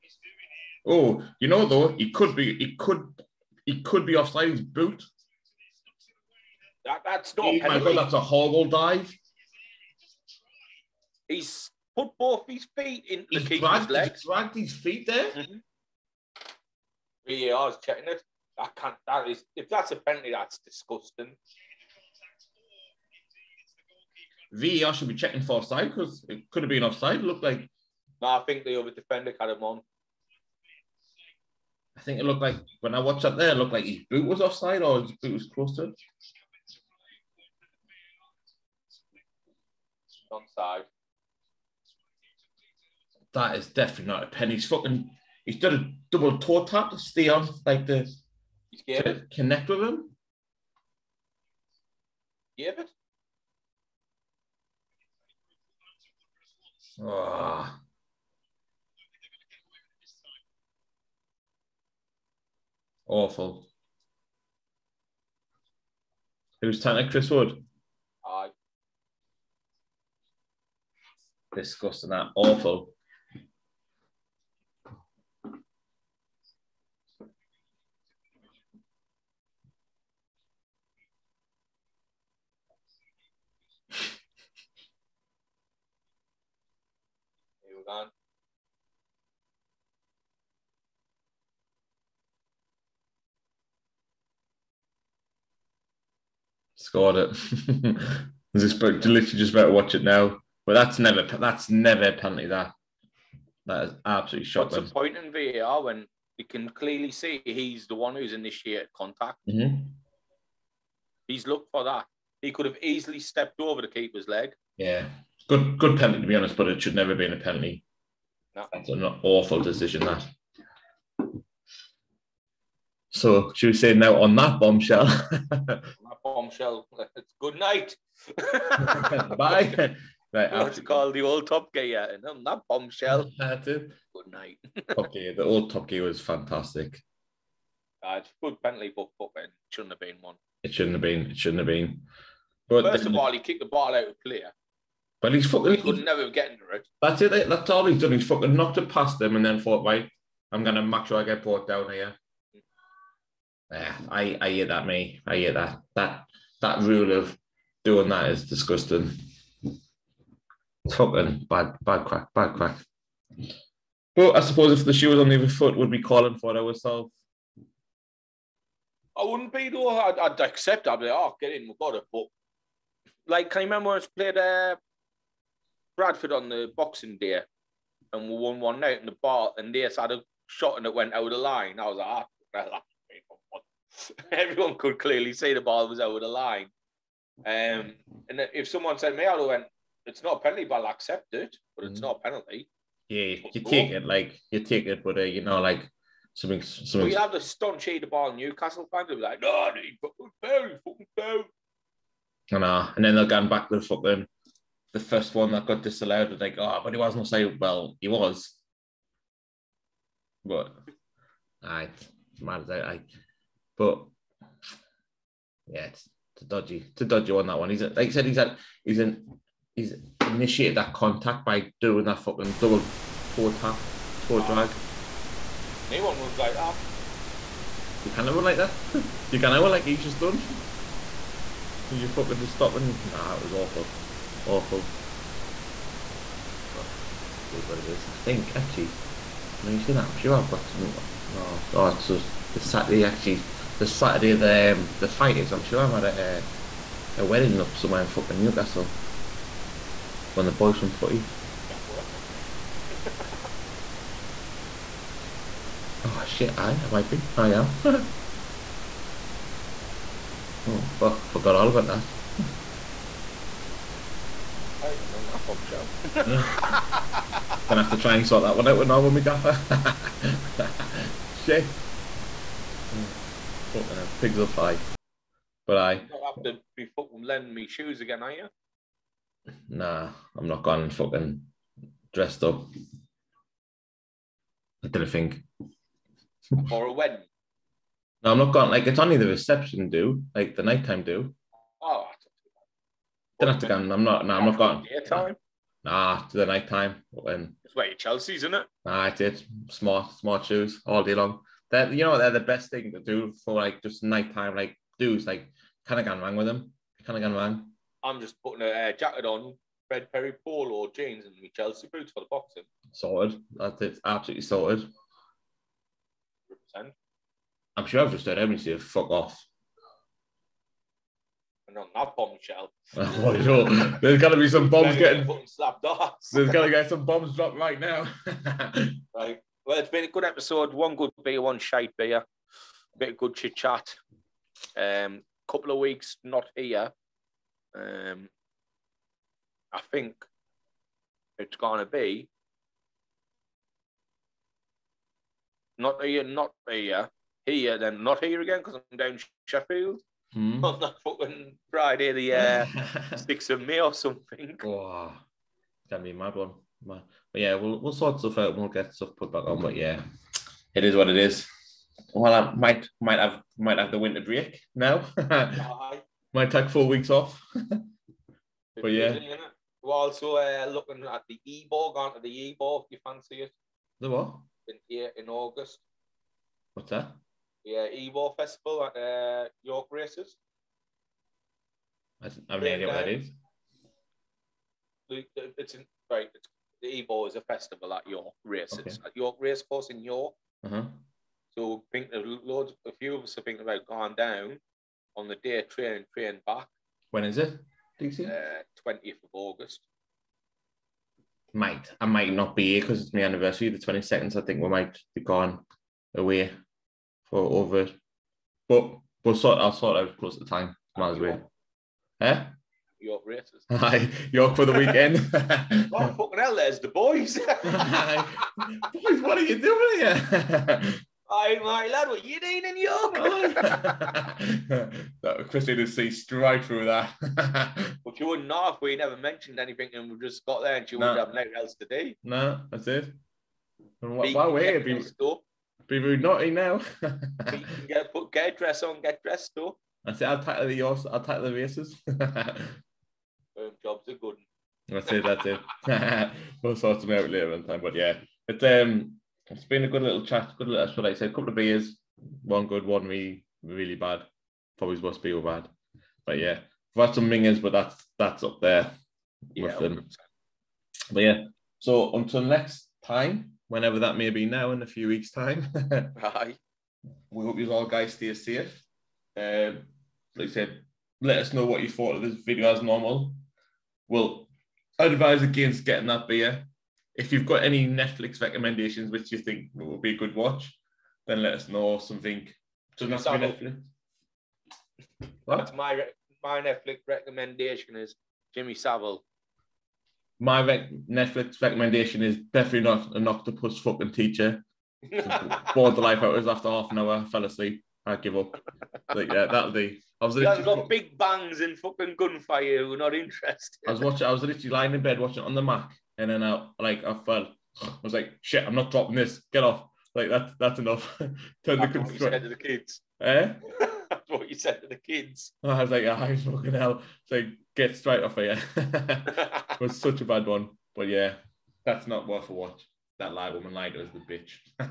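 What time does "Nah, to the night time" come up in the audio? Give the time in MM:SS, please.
04:55.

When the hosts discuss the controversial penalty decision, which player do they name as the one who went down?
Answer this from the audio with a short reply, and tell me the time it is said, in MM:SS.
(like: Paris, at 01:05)
Chris Wood, at 01:07.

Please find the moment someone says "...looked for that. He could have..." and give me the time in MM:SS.
01:51.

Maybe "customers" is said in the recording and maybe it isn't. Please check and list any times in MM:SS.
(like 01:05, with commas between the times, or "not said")
not said.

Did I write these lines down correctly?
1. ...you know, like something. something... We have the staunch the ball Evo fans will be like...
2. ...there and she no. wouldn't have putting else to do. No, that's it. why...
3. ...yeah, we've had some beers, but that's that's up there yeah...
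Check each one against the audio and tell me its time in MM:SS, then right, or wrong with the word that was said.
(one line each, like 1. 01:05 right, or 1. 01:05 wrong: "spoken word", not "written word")
1. 03:15 wrong: "Newcastle", not "Evo"
2. 07:10 wrong: "nothing", not "putting"
3. 07:36 wrong: "mingers", not "beers".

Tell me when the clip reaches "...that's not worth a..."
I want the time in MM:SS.
08:41.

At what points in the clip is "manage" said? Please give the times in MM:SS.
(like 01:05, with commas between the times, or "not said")
not said.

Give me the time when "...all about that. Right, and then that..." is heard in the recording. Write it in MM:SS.
04:21.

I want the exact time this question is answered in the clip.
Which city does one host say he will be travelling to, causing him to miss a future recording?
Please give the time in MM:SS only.
05:49.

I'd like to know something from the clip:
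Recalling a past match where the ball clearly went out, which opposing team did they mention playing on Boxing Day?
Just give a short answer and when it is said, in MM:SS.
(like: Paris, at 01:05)
Bradford, at 02:55.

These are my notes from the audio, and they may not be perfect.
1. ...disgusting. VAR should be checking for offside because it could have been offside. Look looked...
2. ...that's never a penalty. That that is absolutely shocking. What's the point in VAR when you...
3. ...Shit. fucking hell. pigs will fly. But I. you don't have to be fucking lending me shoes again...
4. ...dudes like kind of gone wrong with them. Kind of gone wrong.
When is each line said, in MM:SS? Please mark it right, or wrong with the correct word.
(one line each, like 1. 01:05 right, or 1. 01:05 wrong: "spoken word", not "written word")
1. 00:20 right
2. 01:41 right
3. 04:31 right
4. 05:04 right.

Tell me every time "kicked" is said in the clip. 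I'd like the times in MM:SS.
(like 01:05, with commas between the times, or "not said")
02:23.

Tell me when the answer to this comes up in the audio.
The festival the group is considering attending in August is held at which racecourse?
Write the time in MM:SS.
06:29.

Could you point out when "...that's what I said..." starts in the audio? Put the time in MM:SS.
07:30.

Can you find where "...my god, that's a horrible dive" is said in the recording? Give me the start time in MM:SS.
00:07.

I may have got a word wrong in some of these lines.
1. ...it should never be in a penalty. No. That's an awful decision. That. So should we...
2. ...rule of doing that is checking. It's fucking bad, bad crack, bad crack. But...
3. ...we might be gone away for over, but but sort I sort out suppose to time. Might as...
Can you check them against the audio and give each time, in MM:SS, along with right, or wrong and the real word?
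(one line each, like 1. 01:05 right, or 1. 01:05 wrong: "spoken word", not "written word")
1. 01:56 right
2. 02:36 wrong: "disgusting", not "checking"
3. 06:44 wrong: "close", not "suppose".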